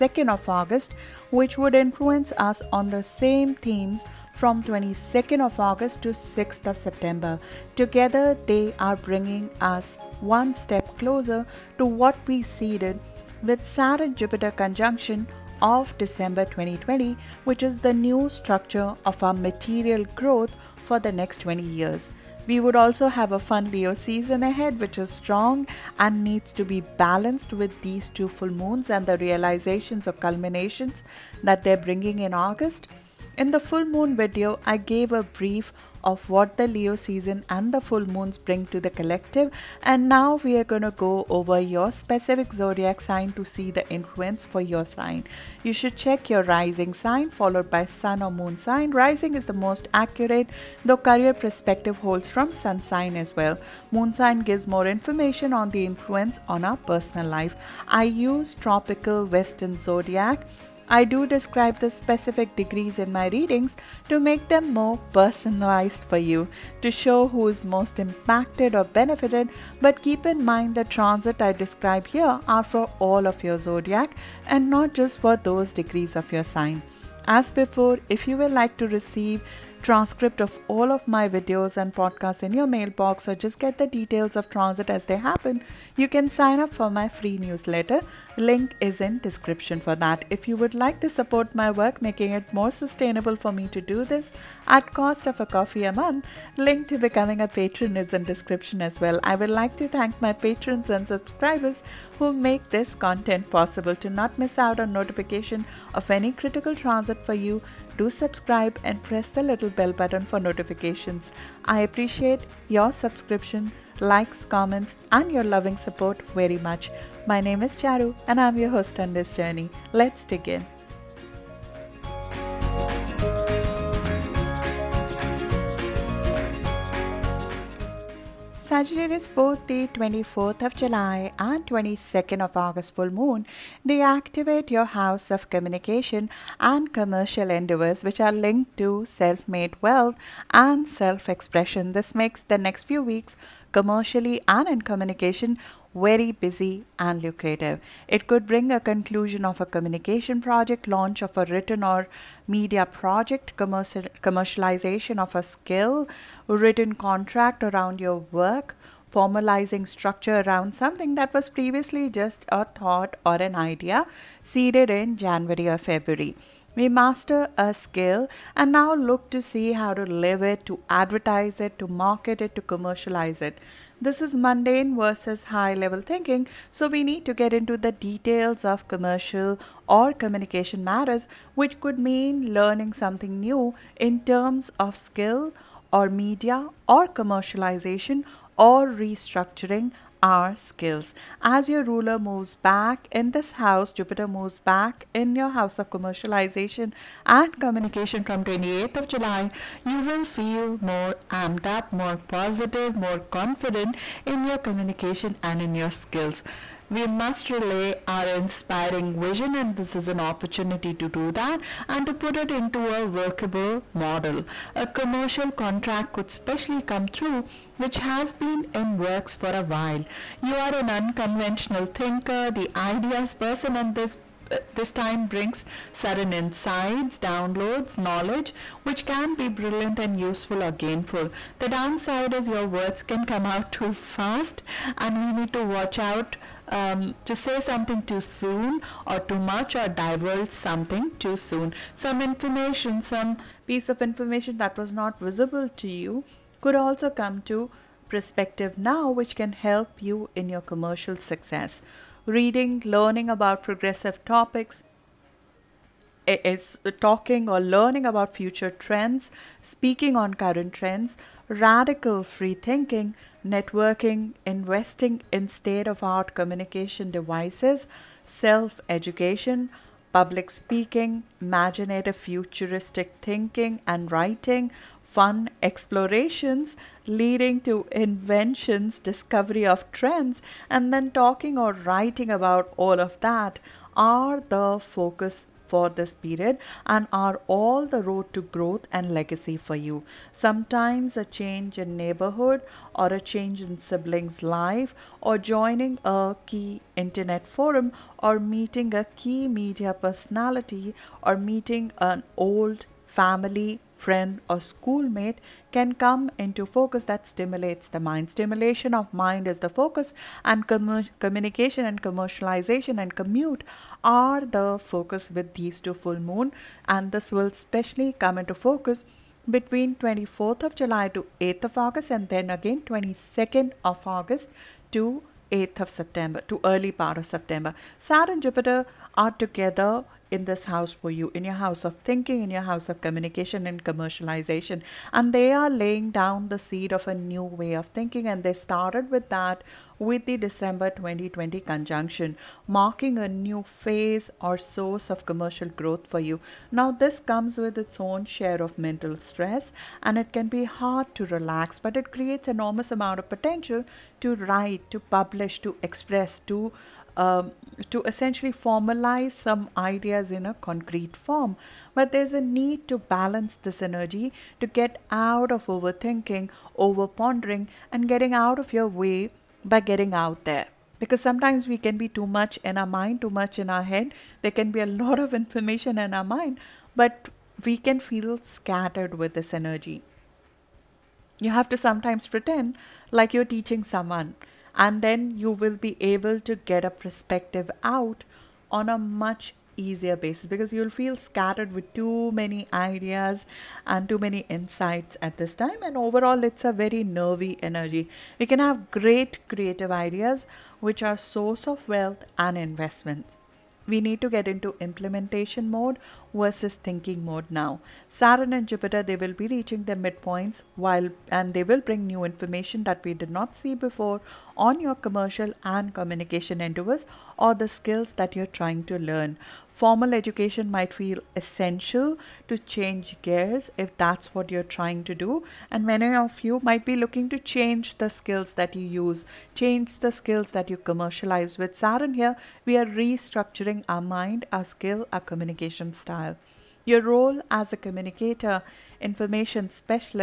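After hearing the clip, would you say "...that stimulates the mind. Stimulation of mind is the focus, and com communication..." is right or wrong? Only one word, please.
right.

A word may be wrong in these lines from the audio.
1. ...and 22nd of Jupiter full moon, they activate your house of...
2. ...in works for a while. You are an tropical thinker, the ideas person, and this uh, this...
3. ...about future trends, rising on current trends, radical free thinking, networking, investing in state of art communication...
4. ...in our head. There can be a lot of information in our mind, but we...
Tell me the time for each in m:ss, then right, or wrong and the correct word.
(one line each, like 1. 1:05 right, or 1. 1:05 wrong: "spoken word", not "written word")
1. 2:11 wrong: "August", not "Jupiter"
2. 3:38 wrong: "unconventional", not "tropical"
3. 4:18 wrong: "speaking", not "rising"
4. 6:13 right.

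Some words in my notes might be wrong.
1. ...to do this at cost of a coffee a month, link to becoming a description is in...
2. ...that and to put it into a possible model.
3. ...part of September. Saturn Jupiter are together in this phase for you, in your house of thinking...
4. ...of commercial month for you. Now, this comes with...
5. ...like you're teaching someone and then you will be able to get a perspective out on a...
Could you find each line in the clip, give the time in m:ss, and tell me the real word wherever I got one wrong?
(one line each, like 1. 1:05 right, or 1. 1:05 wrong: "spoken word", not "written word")
1. 1:33 wrong: "patron", not "description"
2. 3:31 wrong: "workable", not "possible"
3. 5:27 wrong: "house", not "phase"
4. 5:45 wrong: "growth", not "month"
5. 6:23 right.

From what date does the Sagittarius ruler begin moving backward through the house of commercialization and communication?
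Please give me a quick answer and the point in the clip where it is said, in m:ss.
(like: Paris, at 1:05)
28th of July, at 3:18.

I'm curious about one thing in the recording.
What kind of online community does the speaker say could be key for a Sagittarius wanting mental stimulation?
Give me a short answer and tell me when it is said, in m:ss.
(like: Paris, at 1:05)
internet forum, at 4:56.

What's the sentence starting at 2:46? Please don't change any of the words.
We master a skill and now look to see how to live it, to advertise it, to market it, to commercialize it.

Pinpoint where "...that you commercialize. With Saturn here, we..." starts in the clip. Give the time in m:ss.
7:10.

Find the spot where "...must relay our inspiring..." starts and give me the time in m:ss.
3:27.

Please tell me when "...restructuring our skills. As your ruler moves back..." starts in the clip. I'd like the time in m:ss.
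3:08.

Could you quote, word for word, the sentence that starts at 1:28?
Link is in description for that.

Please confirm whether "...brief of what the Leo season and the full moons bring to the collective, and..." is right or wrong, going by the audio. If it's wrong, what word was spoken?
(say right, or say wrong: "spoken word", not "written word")
right.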